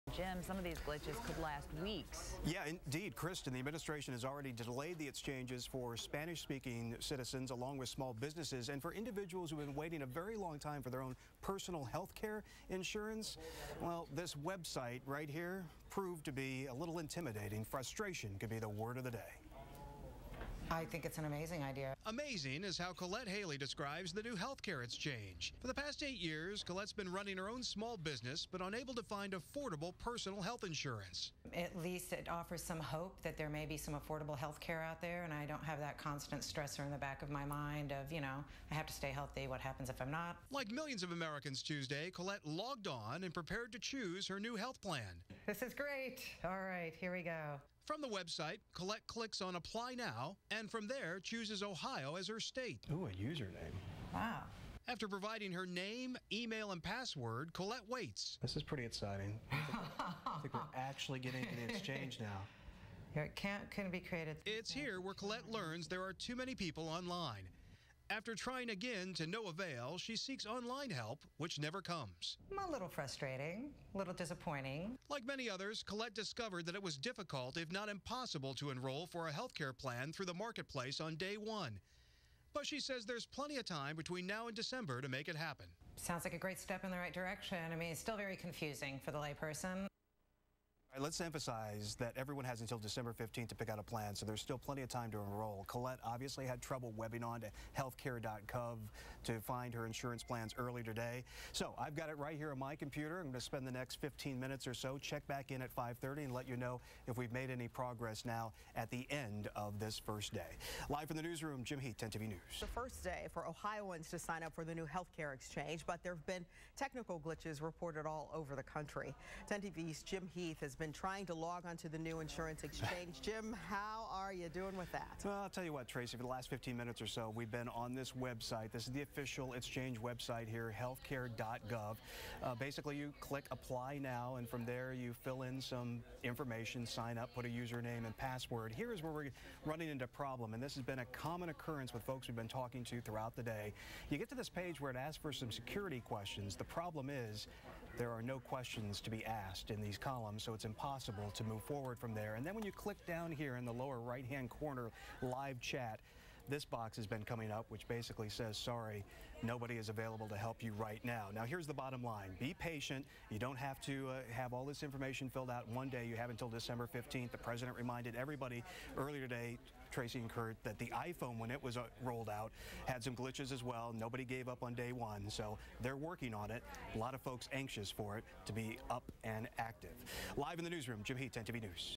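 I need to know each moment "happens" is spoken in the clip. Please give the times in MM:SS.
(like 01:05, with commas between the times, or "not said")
00:39, 01:25.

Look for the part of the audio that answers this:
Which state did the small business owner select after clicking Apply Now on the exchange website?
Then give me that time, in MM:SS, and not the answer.
00:51.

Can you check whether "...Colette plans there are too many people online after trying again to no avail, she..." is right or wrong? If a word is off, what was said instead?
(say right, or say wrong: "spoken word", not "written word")
wrong: "learns", not "plans".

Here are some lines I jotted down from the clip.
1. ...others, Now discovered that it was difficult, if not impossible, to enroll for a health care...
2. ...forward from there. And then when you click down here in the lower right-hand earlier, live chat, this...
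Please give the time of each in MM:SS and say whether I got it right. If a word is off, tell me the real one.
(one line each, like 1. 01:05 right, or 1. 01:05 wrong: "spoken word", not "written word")
1. 01:15 wrong: "Colette", not "Now"
2. 02:31 wrong: "corner", not "earlier".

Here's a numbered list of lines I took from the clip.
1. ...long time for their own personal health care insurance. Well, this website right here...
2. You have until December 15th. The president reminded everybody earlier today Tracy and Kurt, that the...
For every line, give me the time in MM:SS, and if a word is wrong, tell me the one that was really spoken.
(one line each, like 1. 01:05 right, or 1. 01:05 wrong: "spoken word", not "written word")
1. 00:10 right
2. 02:46 right.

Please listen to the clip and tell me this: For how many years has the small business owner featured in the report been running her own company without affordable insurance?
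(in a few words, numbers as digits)
8.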